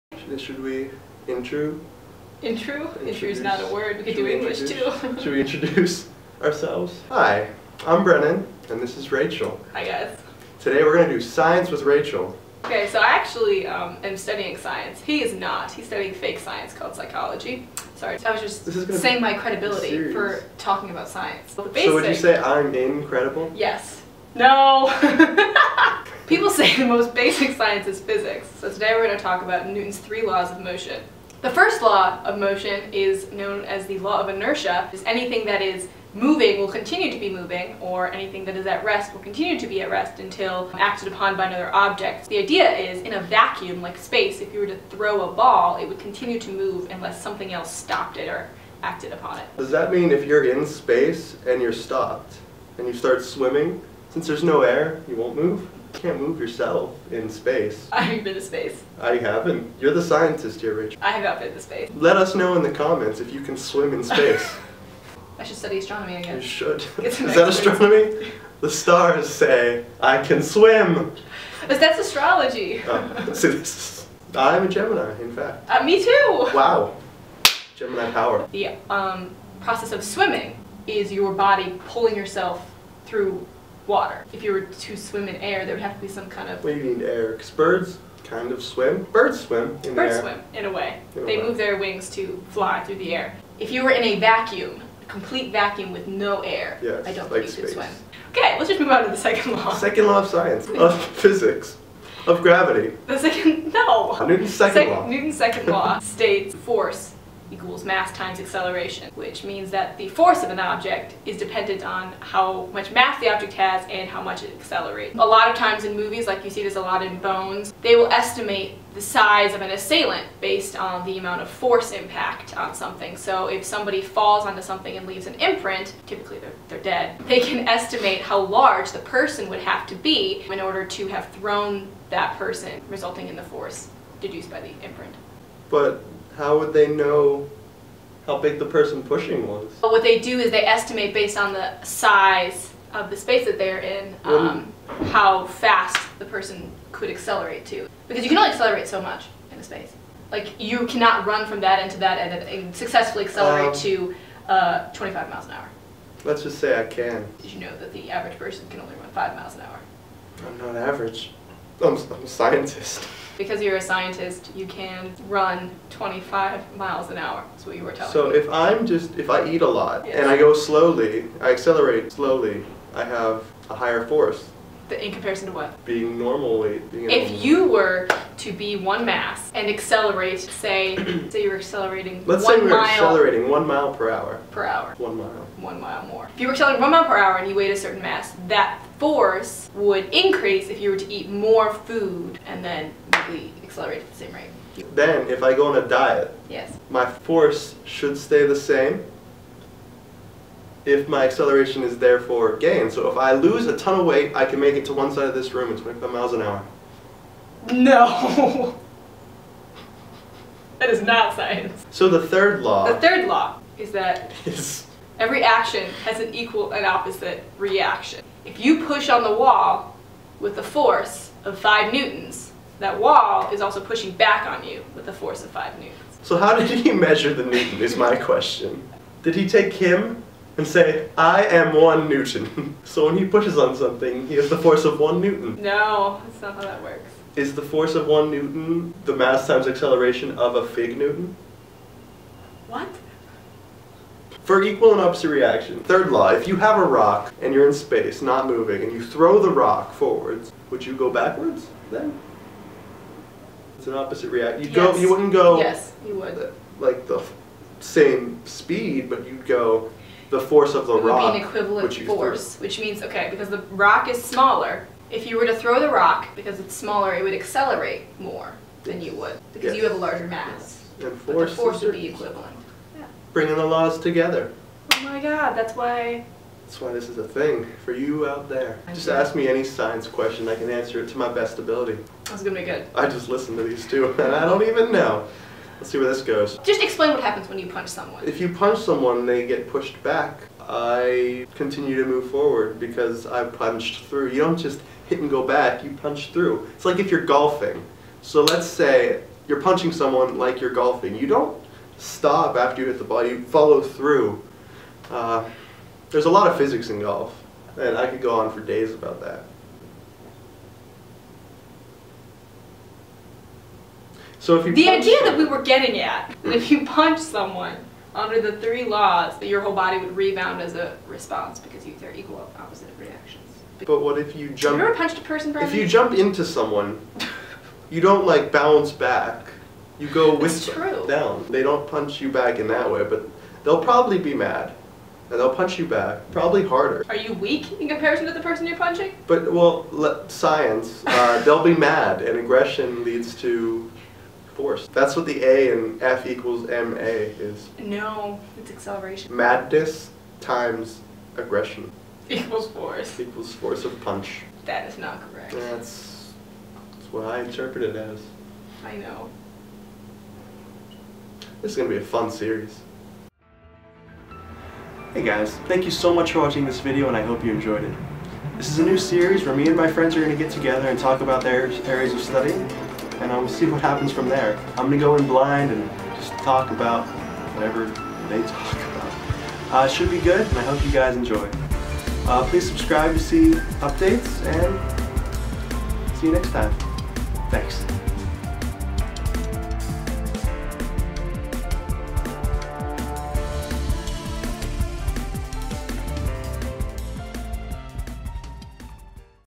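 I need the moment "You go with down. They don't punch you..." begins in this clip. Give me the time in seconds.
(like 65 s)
330 s.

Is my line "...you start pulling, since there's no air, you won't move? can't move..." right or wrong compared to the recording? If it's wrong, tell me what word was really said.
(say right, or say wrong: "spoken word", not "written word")
wrong: "swimming", not "pulling".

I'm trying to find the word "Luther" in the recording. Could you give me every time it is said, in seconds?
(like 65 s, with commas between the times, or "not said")
not said.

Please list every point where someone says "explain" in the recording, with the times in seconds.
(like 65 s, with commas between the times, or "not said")
286 s.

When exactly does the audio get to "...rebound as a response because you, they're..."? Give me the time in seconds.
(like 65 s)
320 s.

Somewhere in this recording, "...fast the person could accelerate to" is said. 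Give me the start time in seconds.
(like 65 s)
145 s.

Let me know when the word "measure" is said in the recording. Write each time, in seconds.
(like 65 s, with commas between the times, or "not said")
226 s.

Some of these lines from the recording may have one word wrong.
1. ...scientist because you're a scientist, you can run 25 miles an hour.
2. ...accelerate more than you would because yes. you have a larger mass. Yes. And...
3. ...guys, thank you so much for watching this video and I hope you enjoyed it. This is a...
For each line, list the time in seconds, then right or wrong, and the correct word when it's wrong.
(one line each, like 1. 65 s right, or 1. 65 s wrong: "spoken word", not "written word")
1. 162 s right
2. 267 s right
3. 365 s right.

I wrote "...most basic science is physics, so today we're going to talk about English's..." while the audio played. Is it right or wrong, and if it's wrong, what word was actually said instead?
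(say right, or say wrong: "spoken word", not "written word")
wrong: "Newton", not "English".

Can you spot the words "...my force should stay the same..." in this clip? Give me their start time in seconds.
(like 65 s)
196 s.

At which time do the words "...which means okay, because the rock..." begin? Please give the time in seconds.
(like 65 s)
262 s.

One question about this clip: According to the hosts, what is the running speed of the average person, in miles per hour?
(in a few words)
5.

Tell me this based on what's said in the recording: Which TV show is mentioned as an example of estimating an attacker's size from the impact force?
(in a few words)
Bones.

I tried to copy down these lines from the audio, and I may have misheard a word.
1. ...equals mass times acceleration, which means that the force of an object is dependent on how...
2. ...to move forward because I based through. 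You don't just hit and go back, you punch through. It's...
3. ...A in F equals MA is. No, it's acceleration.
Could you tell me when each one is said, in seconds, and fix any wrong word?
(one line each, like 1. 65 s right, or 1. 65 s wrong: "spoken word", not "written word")
1. 107 s right
2. 292 s wrong: "punched", not "based"
3. 345 s right.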